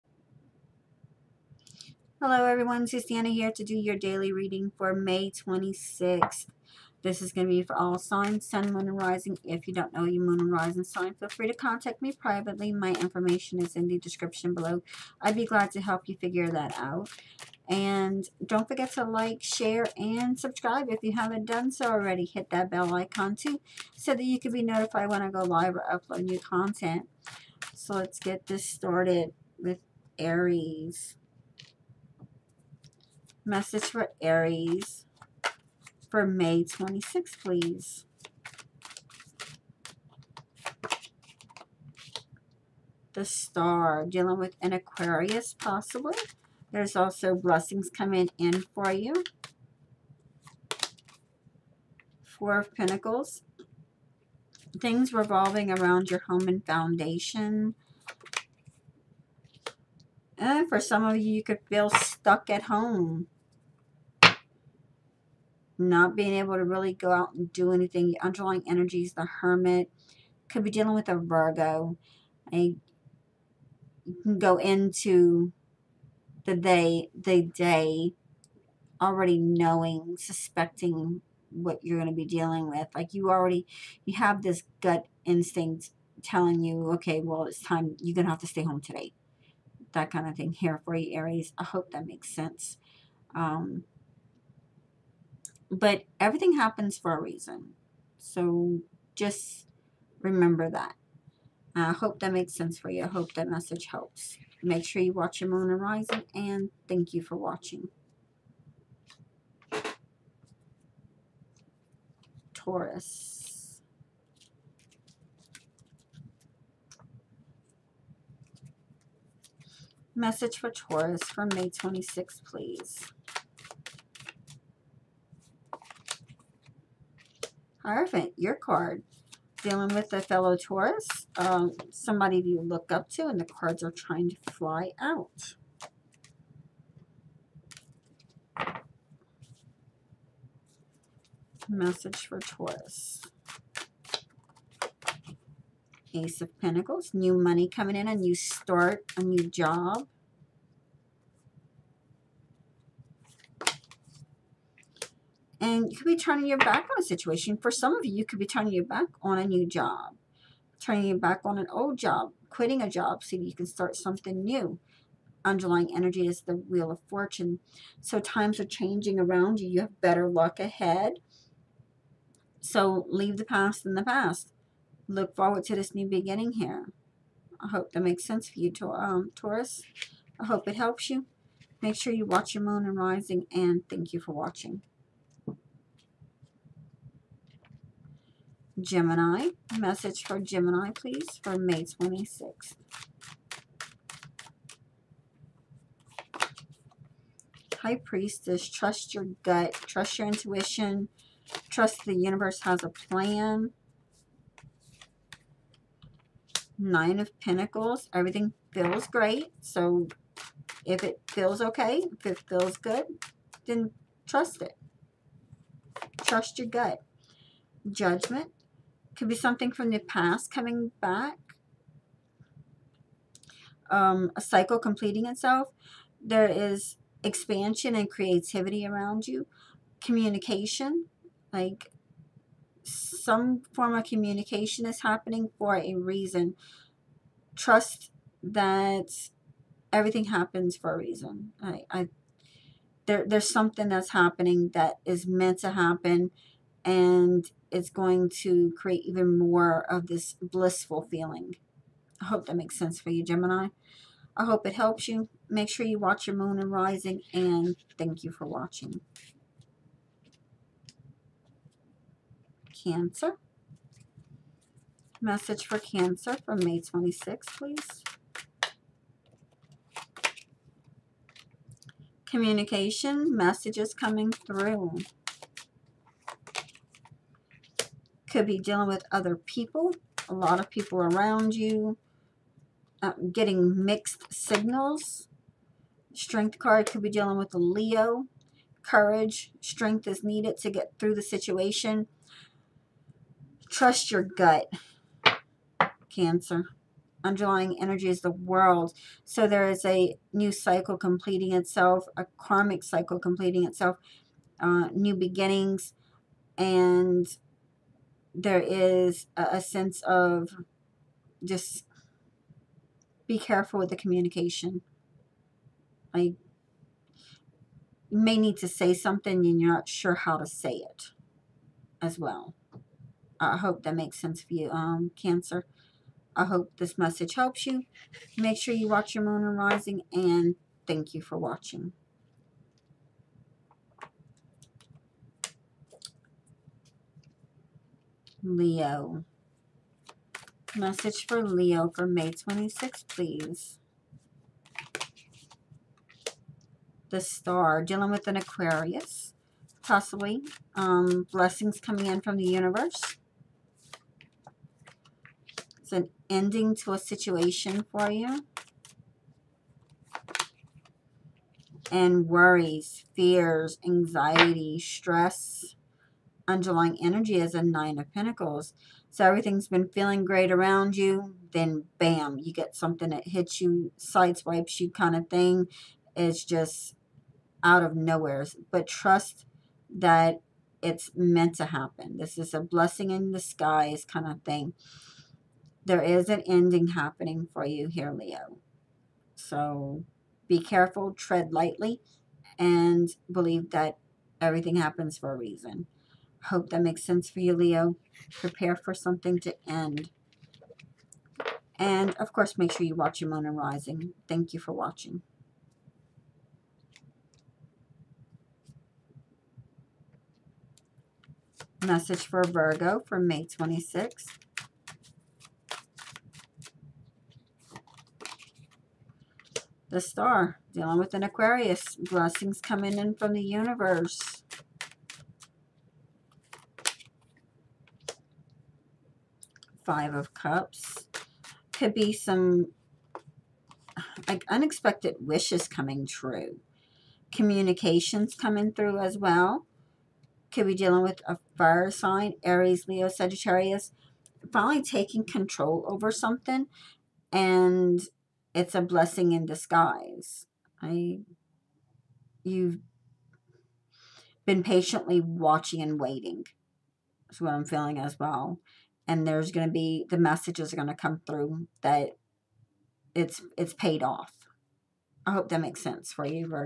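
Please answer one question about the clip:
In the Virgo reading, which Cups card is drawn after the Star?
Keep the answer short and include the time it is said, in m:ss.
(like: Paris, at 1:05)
Five of Cups, at 7:09.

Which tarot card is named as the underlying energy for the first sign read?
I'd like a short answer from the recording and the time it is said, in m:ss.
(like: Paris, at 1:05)
The Hermit, at 1:09.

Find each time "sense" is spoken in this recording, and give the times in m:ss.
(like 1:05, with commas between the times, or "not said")
1:32, 1:42, 2:58, 4:12, 5:09, 5:24, 6:37, 7:45.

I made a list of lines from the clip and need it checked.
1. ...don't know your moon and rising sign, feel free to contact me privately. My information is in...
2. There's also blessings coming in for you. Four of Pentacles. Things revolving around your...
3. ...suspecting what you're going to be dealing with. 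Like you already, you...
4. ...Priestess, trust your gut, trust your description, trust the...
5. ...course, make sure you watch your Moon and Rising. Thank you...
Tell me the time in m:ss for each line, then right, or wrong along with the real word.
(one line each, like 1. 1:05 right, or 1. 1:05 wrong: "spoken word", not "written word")
1. 0:09 right
2. 0:46 right
3. 1:20 right
4. 3:18 wrong: "intuition", not "description"
5. 6:42 right.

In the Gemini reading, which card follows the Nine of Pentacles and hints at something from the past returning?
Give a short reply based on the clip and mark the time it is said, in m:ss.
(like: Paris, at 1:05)
Judgment, at 3:37.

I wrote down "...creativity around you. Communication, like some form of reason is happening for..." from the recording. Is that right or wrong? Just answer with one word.
wrong.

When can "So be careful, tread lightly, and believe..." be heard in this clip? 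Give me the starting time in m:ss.
6:29.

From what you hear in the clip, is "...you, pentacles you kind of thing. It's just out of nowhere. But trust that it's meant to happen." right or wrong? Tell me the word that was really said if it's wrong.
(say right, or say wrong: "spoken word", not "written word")
wrong: "sideswipes", not "pentacles".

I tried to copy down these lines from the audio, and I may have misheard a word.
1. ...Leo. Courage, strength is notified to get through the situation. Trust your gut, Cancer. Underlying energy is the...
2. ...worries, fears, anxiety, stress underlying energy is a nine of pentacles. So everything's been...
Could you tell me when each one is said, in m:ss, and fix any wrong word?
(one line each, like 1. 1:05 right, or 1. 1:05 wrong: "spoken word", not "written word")
1. 4:47 wrong: "needed", not "notified"
2. 6:02 right.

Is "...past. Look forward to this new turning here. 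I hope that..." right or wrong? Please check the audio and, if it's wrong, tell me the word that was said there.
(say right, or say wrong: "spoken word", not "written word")
wrong: "beginning", not "turning".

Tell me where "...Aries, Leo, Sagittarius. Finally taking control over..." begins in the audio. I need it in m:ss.
7:22.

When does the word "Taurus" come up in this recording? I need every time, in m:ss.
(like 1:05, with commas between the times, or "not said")
1:52, 2:00, 2:10, 2:22, 2:59.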